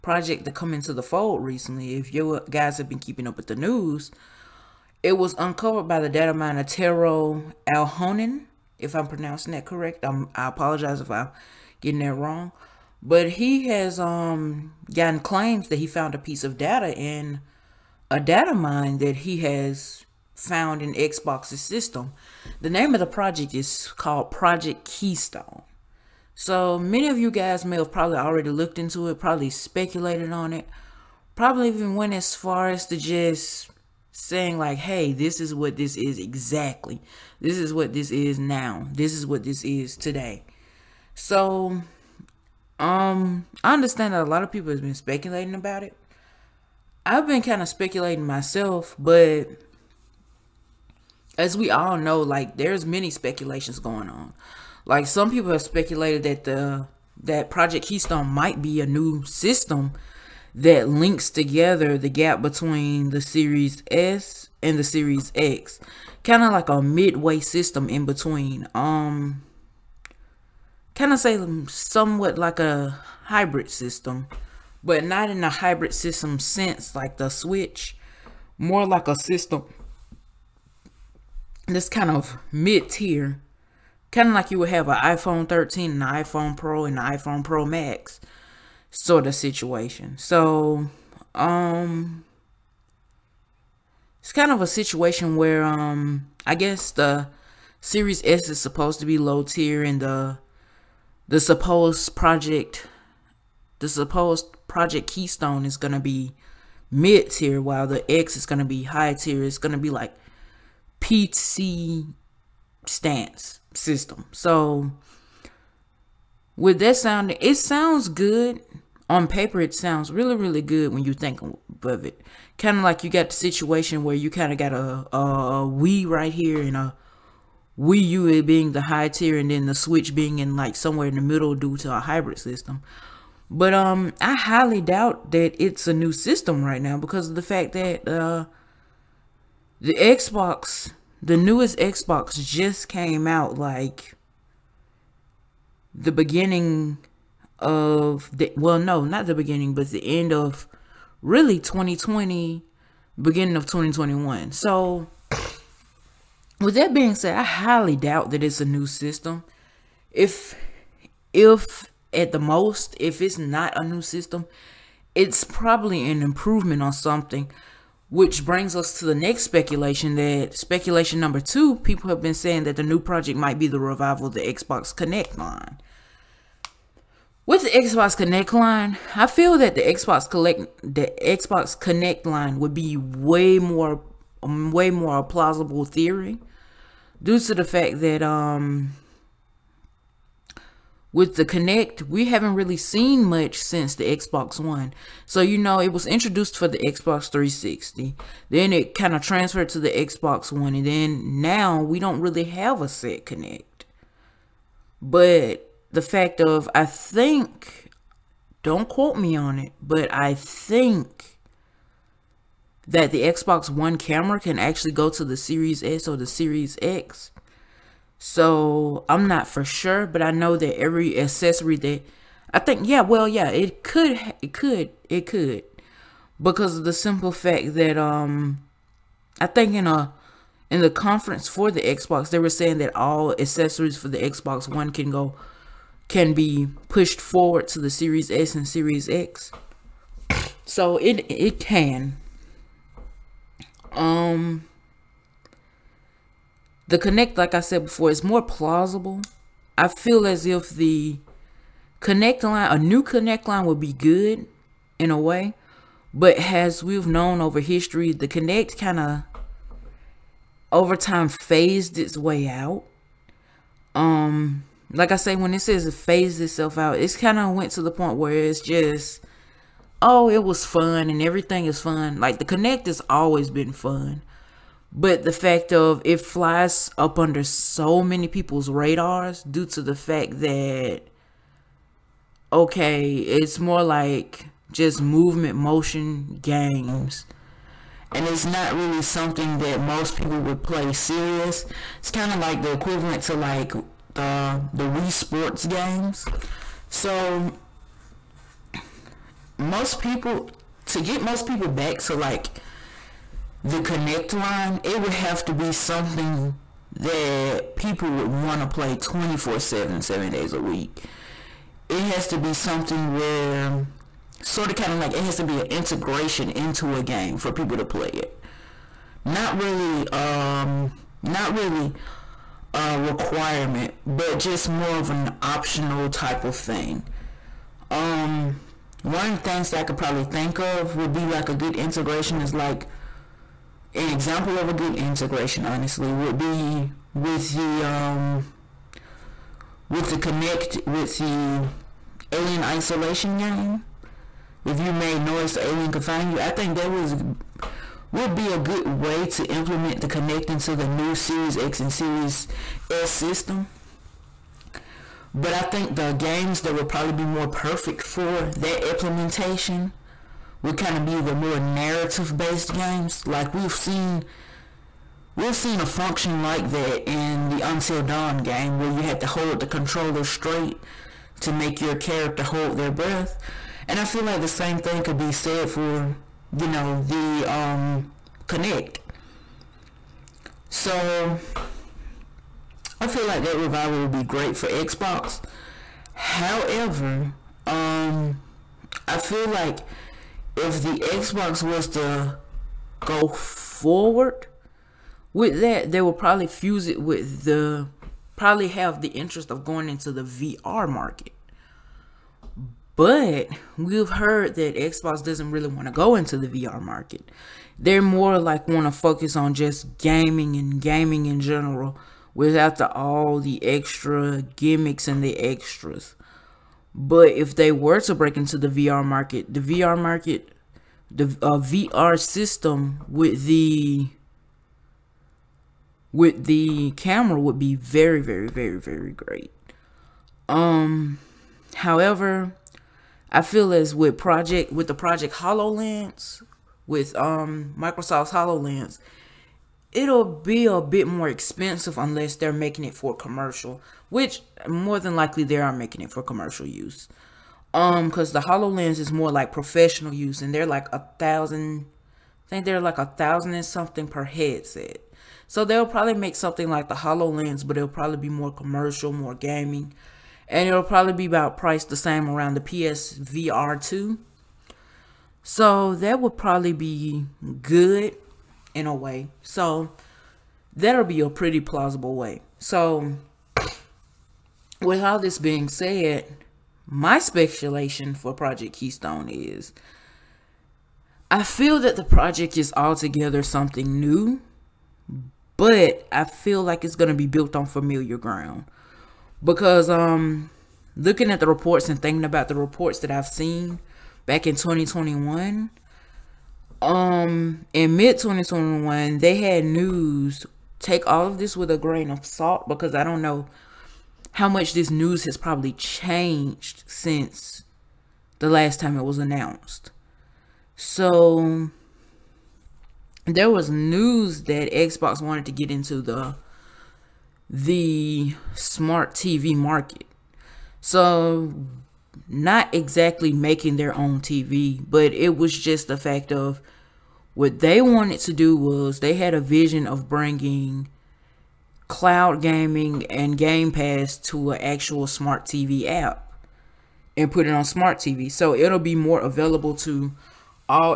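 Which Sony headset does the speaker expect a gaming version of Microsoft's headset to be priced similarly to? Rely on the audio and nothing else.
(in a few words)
PSVR 2.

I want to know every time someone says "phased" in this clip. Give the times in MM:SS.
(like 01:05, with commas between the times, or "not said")
04:21, 04:25.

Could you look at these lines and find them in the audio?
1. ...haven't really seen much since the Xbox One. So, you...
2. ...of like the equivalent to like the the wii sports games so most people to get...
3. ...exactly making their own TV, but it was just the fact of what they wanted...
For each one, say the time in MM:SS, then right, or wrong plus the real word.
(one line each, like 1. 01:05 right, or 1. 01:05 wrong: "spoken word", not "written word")
1. 03:12 right
2. 04:52 right
3. 08:42 right.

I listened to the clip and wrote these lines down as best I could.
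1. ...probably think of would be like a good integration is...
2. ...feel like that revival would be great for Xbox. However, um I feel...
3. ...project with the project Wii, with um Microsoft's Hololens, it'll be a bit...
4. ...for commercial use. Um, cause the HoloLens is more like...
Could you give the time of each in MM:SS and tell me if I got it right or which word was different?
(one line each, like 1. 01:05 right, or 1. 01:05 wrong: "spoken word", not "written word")
1. 05:29 right
2. 06:23 right
3. 07:14 wrong: "Hololens", not "Wii"
4. 07:26 right.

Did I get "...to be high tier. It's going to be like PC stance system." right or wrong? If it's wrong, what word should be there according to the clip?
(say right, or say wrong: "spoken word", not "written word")
right.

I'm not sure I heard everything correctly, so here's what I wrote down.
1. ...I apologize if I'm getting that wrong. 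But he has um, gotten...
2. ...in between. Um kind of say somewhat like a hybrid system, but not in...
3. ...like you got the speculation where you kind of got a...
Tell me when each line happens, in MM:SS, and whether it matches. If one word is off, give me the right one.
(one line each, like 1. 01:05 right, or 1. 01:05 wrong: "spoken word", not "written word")
1. 00:10 right
2. 01:07 right
3. 02:02 wrong: "situation", not "speculation".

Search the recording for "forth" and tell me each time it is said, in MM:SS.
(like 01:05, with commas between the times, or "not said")
not said.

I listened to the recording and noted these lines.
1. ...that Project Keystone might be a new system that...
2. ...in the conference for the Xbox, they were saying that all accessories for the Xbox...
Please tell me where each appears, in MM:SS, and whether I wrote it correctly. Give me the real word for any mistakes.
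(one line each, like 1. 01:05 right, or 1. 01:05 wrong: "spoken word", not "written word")
1. 00:57 right
2. 03:50 right.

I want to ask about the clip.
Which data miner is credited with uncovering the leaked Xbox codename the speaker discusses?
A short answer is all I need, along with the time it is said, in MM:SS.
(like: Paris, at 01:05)
Tero Alhonen, at 00:06.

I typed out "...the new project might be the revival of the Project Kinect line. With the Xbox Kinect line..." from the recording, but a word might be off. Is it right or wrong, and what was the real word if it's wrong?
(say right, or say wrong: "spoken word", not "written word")
wrong: "Xbox", not "Project".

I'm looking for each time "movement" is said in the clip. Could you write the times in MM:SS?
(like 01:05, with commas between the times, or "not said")
04:45.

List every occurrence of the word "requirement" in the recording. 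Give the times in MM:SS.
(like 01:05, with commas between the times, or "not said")
05:22.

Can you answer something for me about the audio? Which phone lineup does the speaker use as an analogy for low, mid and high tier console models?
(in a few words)
iPhone 13.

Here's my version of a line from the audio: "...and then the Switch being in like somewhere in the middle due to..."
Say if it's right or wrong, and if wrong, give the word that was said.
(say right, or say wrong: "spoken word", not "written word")
right.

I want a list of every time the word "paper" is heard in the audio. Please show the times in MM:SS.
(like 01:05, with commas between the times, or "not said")
01:59.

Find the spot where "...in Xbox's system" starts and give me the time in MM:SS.
00:20.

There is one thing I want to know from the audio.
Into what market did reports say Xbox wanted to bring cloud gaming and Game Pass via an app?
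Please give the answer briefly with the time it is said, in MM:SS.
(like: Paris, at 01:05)
smart TV market, at 08:38.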